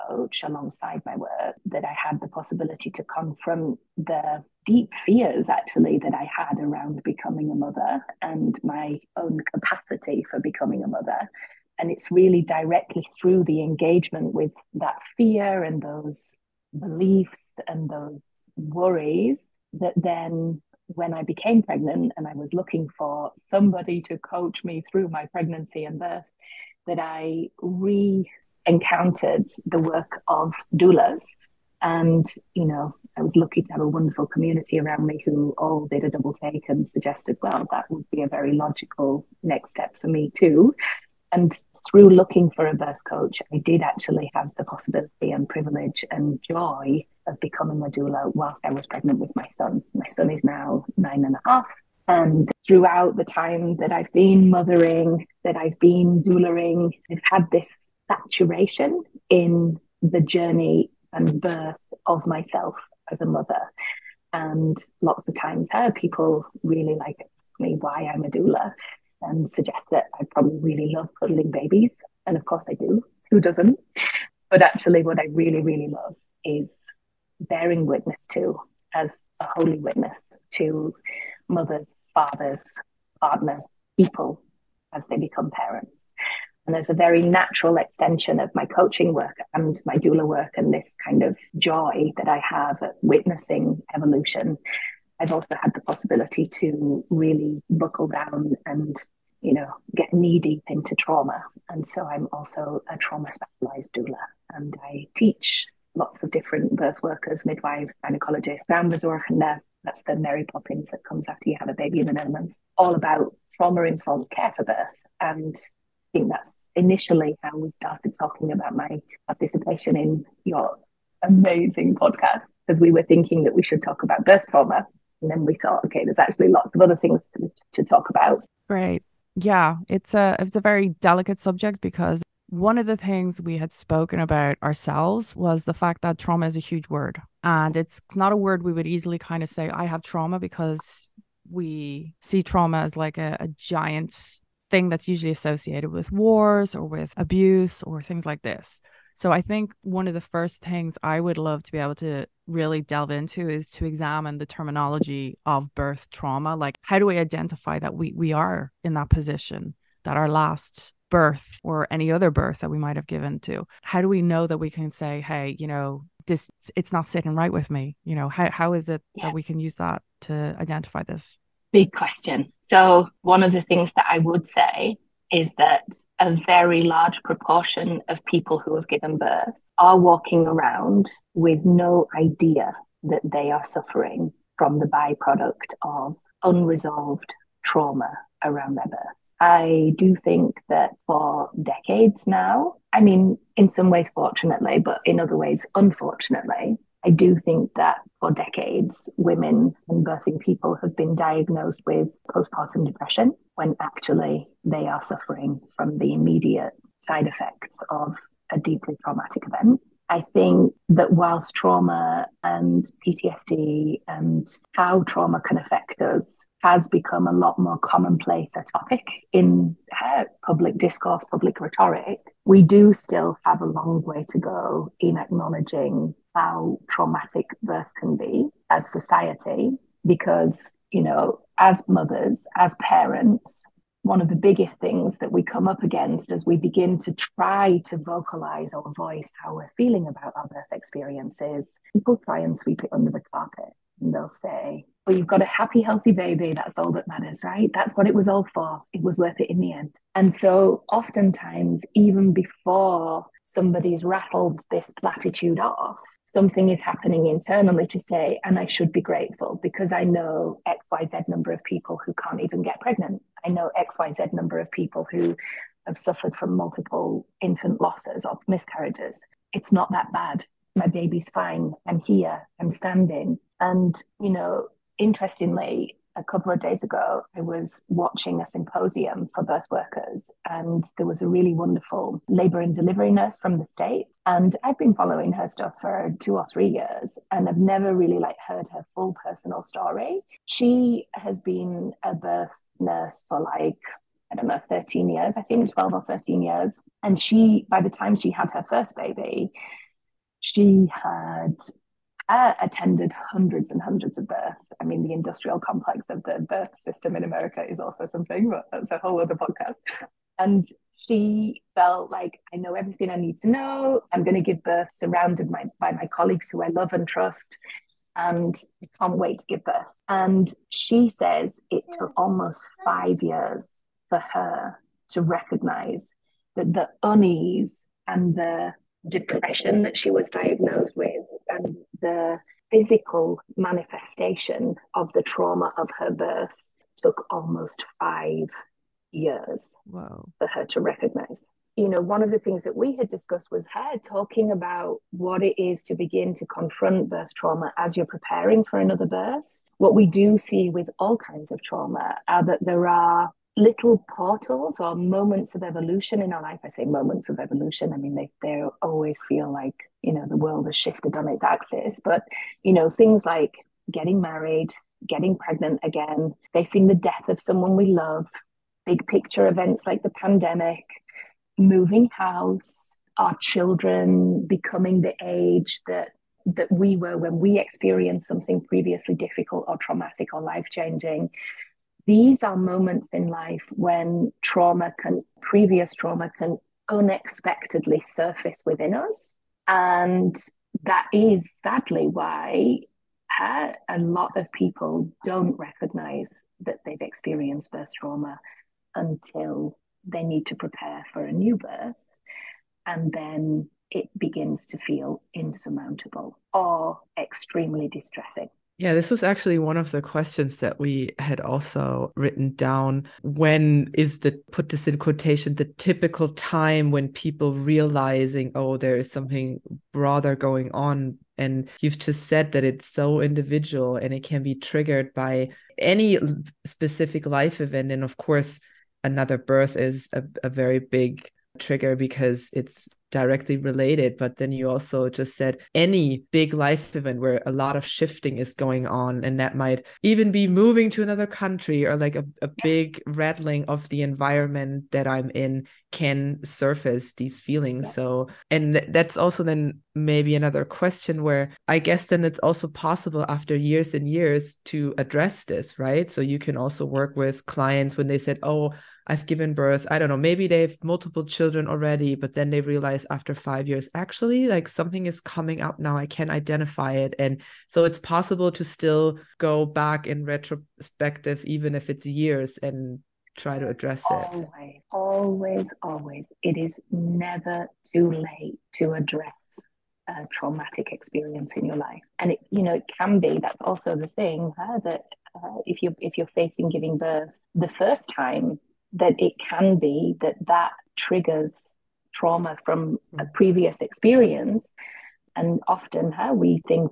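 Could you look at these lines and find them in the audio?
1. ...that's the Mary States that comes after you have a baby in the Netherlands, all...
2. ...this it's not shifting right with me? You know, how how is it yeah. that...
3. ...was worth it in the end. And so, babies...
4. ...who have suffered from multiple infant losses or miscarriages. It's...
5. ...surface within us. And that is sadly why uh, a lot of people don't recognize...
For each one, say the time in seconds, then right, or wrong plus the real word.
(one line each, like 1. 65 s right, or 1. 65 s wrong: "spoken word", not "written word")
1. 109 s wrong: "Poppins", not "States"
2. 166 s wrong: "sitting", not "shifting"
3. 249 s wrong: "oftentimes", not "babies"
4. 265 s right
5. 387 s right.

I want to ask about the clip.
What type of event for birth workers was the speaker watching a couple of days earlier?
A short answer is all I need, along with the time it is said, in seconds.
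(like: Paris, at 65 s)
a symposium, at 278 s.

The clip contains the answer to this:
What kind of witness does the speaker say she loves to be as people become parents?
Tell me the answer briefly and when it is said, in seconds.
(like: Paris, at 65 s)
holy witness, at 79 s.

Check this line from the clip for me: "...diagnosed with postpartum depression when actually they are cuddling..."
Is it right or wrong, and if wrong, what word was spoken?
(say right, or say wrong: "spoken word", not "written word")
wrong: "suffering", not "cuddling".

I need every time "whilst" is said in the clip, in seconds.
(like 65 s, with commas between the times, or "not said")
48 s, 211 s.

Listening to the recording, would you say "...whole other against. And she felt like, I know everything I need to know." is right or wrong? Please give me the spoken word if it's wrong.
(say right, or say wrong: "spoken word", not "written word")
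wrong: "podcast", not "against".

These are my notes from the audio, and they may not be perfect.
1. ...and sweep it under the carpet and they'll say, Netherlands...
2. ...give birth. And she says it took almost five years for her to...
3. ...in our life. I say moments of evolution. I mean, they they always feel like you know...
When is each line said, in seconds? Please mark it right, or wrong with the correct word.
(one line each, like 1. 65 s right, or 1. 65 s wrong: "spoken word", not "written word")
1. 242 s wrong: "Well", not "Netherlands"
2. 319 s right
3. 356 s right.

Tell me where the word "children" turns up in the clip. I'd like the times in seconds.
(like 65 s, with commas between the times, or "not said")
373 s, 461 s.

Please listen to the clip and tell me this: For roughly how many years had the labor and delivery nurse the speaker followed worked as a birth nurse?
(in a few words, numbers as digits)
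12 or 13 years.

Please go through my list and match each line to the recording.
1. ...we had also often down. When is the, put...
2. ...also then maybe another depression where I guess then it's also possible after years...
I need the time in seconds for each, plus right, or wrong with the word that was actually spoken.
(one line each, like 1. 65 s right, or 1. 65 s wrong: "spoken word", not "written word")
1. 410 s wrong: "written", not "often"
2. 449 s wrong: "question", not "depression".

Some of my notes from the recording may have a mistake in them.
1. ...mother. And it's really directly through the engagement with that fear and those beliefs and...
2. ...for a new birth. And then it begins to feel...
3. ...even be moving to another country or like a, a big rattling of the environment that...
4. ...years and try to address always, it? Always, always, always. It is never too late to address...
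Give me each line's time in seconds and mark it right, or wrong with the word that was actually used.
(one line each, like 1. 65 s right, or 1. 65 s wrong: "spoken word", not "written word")
1. 10 s right
2. 401 s right
3. 440 s right
4. 472 s right.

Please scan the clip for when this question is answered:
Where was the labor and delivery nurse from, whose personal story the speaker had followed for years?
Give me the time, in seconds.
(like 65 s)
283 s.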